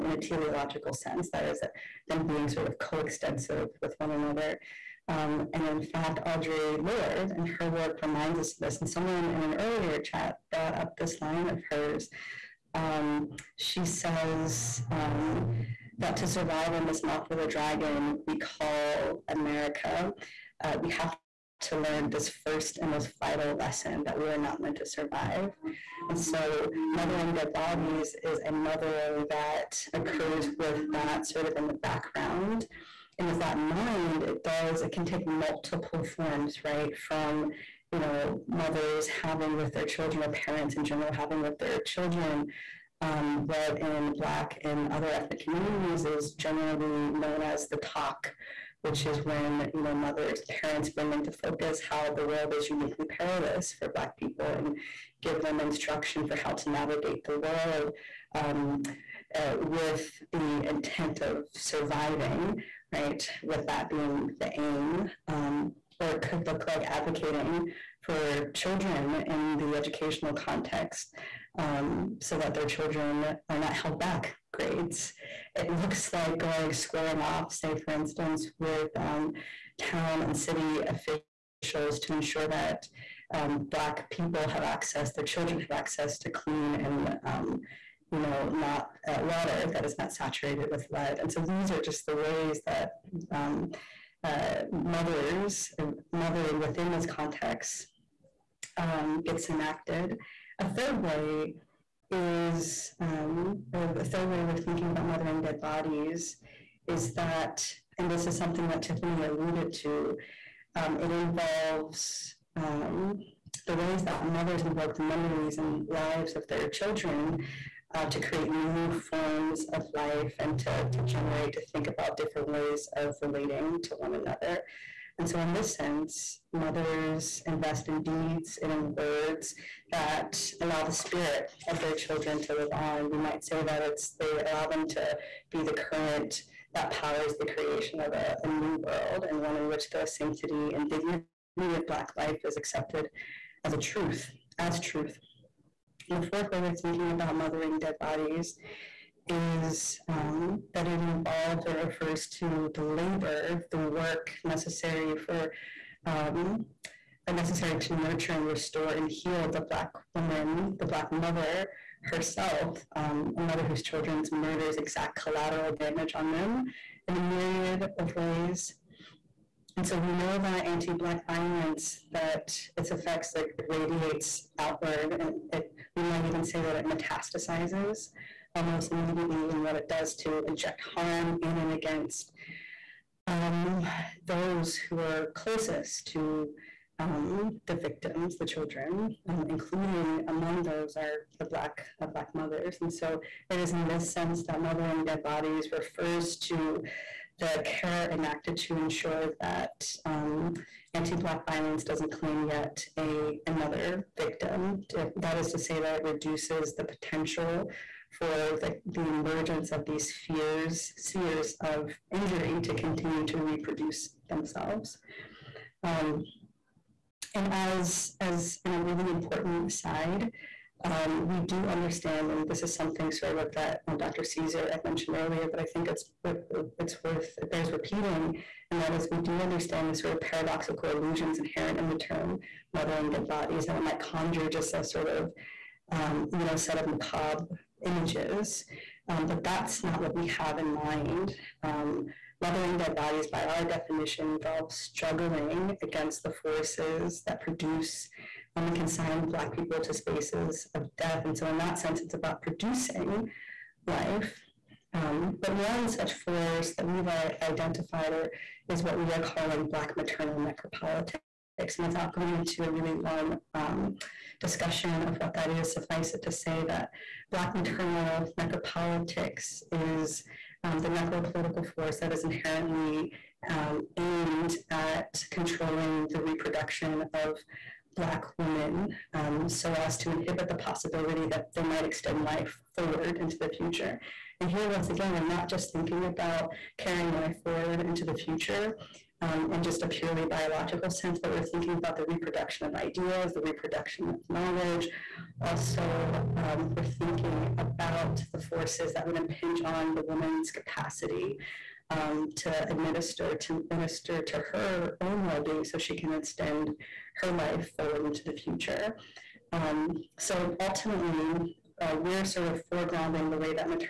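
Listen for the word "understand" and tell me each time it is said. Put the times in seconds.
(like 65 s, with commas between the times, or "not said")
221 s, 229 s.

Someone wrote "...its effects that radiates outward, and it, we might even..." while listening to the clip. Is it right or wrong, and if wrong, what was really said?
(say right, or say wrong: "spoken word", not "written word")
right.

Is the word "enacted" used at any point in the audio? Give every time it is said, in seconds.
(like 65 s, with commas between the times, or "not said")
99 s, 198 s.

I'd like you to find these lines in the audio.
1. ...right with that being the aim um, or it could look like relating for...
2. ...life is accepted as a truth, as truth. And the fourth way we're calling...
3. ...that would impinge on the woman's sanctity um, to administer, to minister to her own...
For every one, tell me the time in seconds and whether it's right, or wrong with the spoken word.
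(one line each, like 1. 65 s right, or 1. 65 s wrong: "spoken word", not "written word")
1. 62 s wrong: "advocating", not "relating"
2. 142 s wrong: "thinking", not "calling"
3. 298 s wrong: "capacity", not "sanctity".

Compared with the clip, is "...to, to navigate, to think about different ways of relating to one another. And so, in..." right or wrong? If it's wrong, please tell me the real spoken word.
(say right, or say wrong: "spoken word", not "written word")
wrong: "generate", not "navigate".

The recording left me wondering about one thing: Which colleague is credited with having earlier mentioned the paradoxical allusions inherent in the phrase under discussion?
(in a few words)
Dr. Caesar.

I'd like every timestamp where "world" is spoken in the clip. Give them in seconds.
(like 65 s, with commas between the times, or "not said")
52 s, 57 s, 138 s.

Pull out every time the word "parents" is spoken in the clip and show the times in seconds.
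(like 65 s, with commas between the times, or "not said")
40 s, 50 s.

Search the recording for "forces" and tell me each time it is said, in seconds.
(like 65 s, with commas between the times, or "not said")
246 s, 256 s, 271 s, 298 s.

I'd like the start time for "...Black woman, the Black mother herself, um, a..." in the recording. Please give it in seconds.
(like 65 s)
159 s.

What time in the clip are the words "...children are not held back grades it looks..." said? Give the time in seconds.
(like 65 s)
72 s.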